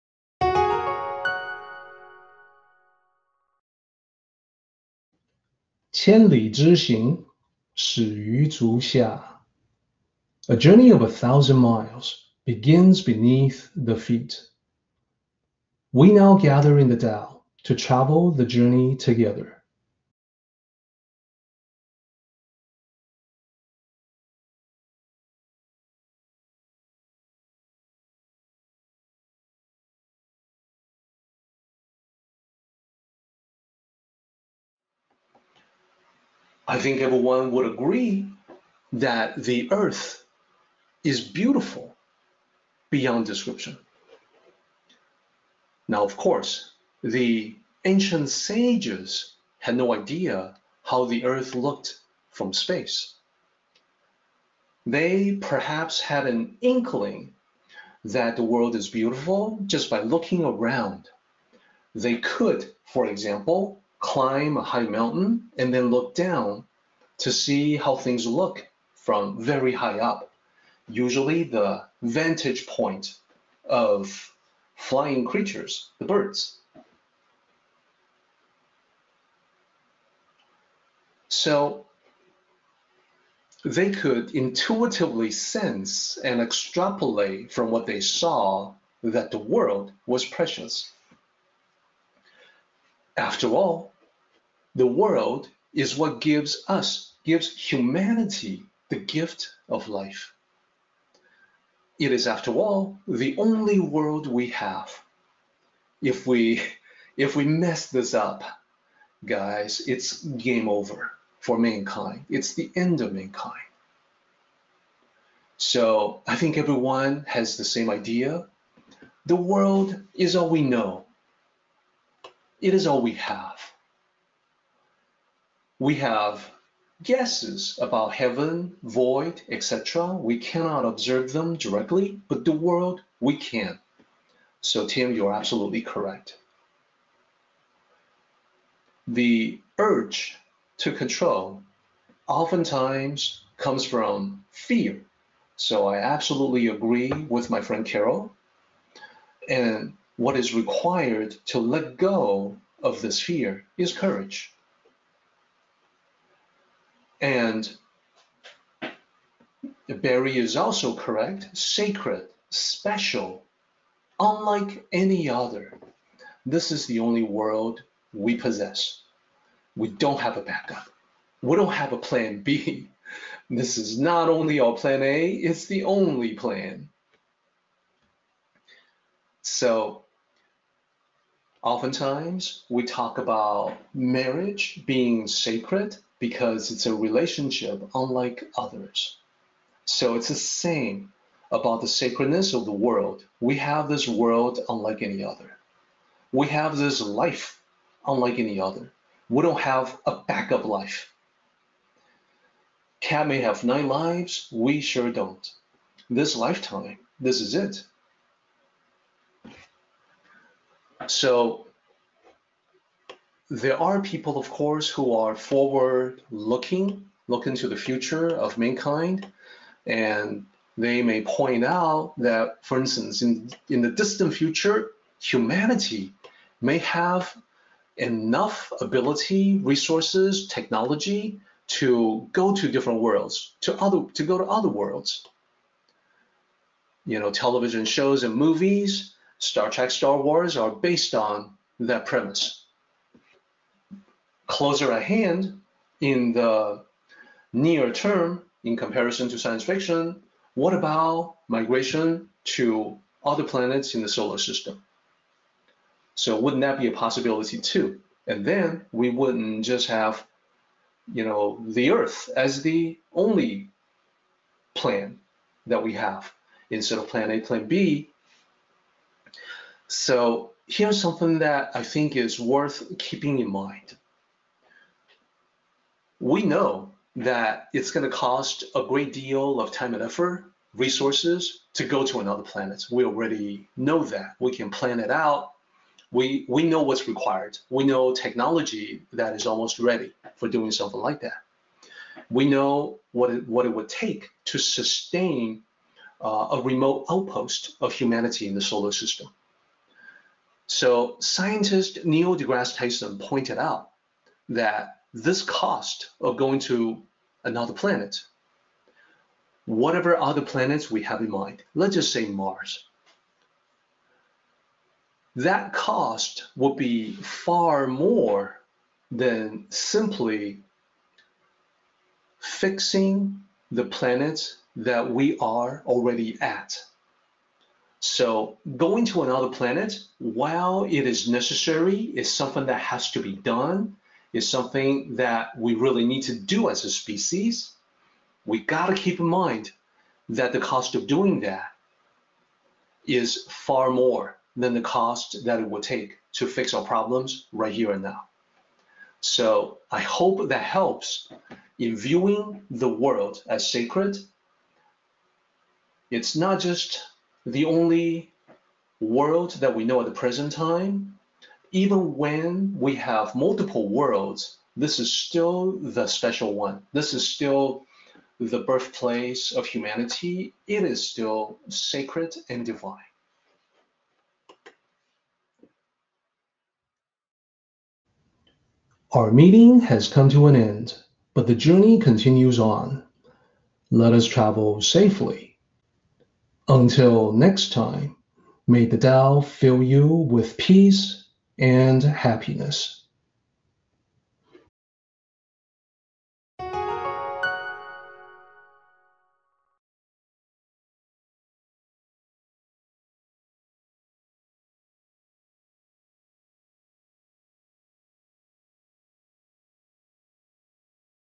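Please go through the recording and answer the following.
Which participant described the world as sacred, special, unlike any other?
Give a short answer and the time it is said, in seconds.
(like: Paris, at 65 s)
Barry, at 159 s.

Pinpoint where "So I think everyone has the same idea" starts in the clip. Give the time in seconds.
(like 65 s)
115 s.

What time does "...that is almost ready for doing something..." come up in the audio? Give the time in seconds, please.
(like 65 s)
289 s.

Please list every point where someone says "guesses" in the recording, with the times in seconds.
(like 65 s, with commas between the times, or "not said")
127 s.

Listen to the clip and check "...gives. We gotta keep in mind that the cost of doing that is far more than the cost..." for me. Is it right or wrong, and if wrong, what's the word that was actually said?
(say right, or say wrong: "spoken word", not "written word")
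wrong: "species", not "gives".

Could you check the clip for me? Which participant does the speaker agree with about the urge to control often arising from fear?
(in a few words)
Tim.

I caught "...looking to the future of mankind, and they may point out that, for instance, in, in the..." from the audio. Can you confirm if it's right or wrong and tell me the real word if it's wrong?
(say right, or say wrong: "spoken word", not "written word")
right.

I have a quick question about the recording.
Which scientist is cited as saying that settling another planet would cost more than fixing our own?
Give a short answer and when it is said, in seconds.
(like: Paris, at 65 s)
Neil deGrasse Tyson, at 302 s.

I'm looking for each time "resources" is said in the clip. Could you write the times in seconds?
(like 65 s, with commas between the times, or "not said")
229 s, 280 s.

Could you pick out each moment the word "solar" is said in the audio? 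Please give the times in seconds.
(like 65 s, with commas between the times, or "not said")
254 s, 298 s.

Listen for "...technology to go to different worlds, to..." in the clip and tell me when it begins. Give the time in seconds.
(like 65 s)
230 s.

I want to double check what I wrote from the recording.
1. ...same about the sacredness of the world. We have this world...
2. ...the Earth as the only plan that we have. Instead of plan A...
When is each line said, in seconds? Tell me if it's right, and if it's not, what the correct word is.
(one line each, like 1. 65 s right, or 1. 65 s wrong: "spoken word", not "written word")
1. 190 s right
2. 261 s right.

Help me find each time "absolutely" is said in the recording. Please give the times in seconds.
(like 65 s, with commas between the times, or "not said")
135 s, 145 s.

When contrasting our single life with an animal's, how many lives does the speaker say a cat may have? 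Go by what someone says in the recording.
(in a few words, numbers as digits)
9.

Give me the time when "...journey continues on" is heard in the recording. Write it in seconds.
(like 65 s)
381 s.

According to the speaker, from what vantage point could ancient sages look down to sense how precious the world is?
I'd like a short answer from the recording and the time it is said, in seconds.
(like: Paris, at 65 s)
A high mountain, at 64 s.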